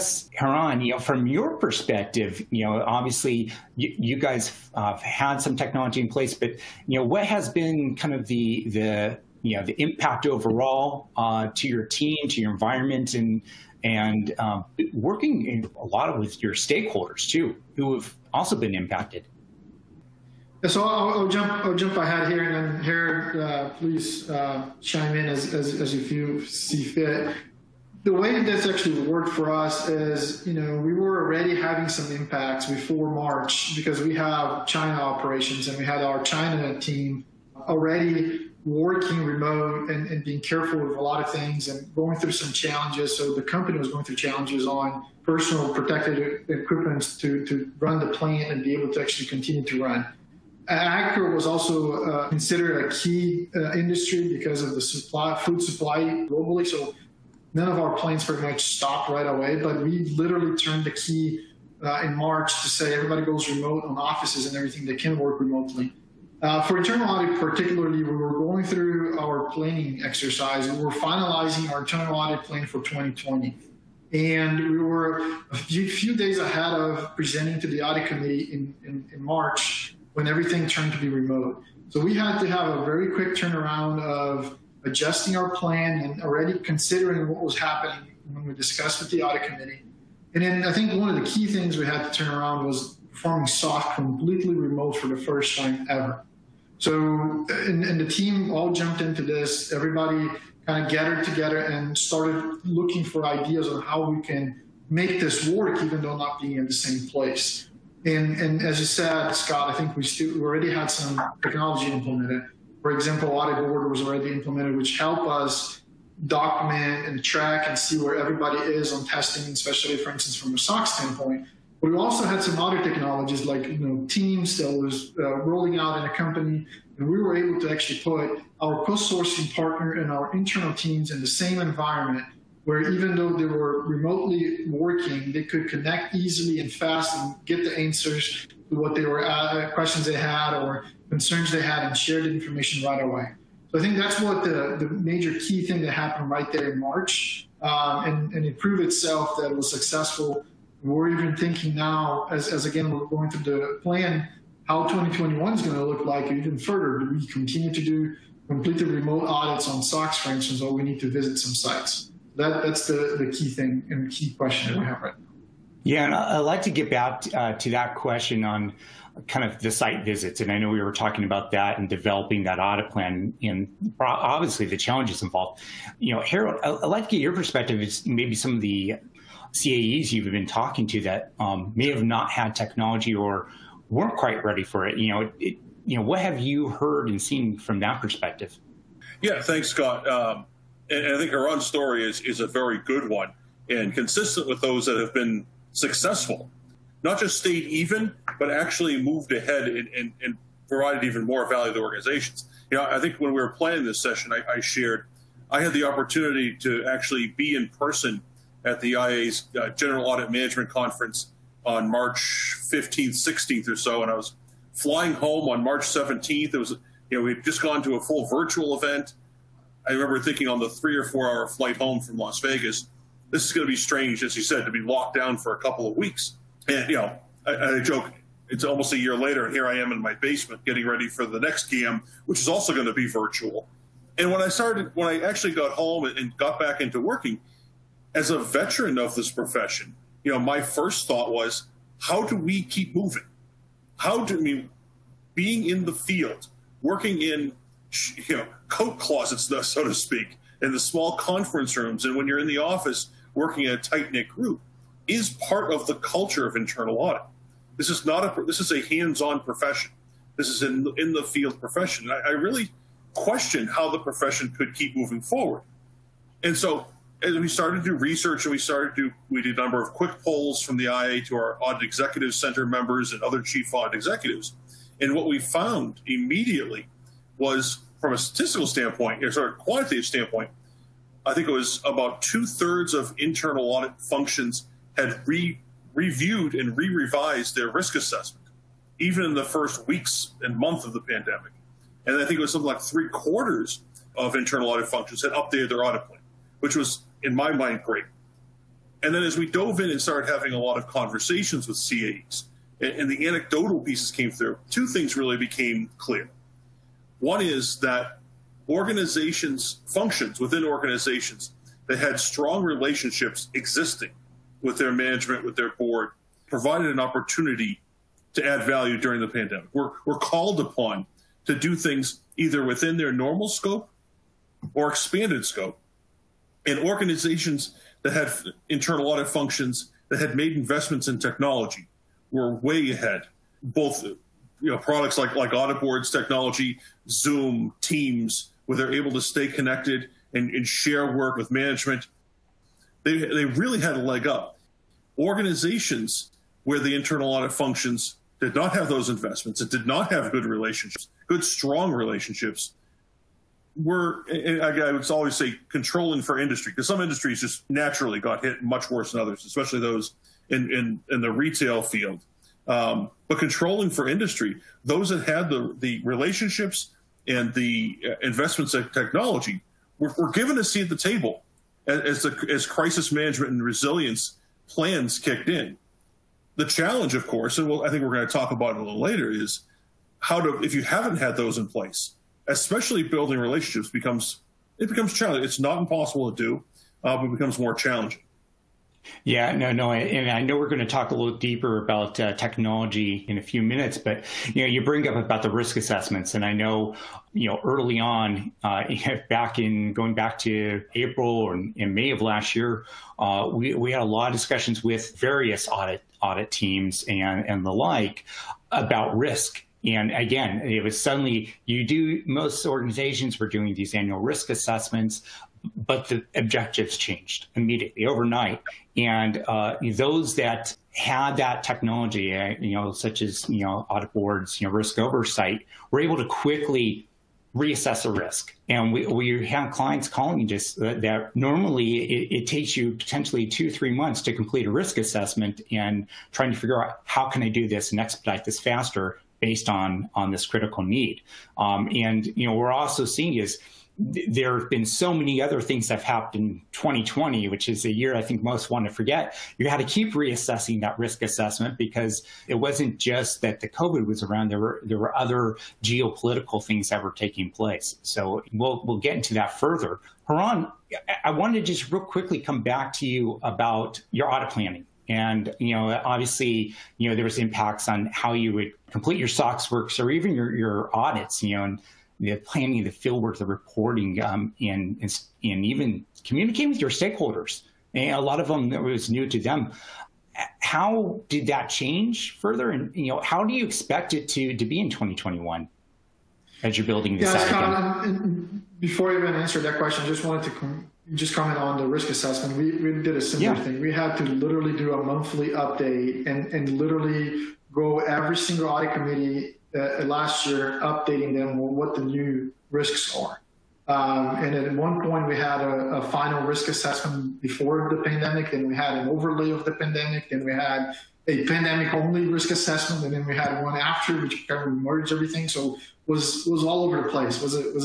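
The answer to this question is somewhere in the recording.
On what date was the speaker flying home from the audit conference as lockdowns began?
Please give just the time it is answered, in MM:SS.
03:35.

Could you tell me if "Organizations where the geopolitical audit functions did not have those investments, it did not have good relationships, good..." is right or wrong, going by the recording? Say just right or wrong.
wrong.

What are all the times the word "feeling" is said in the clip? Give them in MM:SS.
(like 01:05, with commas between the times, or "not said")
not said.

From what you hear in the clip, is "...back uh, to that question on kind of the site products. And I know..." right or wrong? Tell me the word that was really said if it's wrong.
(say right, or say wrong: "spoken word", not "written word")
wrong: "visits", not "products".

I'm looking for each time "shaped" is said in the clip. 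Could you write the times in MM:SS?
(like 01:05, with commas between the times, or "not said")
not said.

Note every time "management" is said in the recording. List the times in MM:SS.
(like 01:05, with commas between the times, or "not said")
03:30, 05:14, 05:41, 06:13.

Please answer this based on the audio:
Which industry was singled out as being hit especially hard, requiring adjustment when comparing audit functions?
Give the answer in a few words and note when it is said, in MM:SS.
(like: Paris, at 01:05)
Retail, at 06:01.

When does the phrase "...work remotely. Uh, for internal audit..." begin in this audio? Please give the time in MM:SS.
01:05.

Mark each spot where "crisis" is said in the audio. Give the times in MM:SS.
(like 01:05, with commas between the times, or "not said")
06:12.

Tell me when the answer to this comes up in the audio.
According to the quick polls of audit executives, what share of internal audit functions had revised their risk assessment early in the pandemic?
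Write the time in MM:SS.
04:42.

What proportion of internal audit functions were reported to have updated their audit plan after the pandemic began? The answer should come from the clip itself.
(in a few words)
Three quarters.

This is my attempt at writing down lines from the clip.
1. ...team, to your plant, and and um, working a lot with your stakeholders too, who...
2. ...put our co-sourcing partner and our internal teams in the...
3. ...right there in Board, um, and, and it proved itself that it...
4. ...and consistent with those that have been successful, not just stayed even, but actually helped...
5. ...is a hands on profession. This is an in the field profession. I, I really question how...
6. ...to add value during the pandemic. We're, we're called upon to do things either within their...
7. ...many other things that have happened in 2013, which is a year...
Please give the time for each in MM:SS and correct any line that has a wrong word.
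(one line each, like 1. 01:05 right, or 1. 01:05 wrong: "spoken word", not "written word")
1. 00:11 wrong: "environment", not "plant"
2. 02:07 right
3. 02:26 wrong: "March", not "Board"
4. 03:13 wrong: "moved", not "helped"
5. 04:18 right
6. 05:18 right
7. 07:25 wrong: "2020", not "2013".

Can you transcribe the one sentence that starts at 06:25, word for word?
It's not impossible to do, uh, but it becomes more challenging.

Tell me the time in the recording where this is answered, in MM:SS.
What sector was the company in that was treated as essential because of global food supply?
00:50.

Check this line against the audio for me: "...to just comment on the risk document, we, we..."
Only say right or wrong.
wrong.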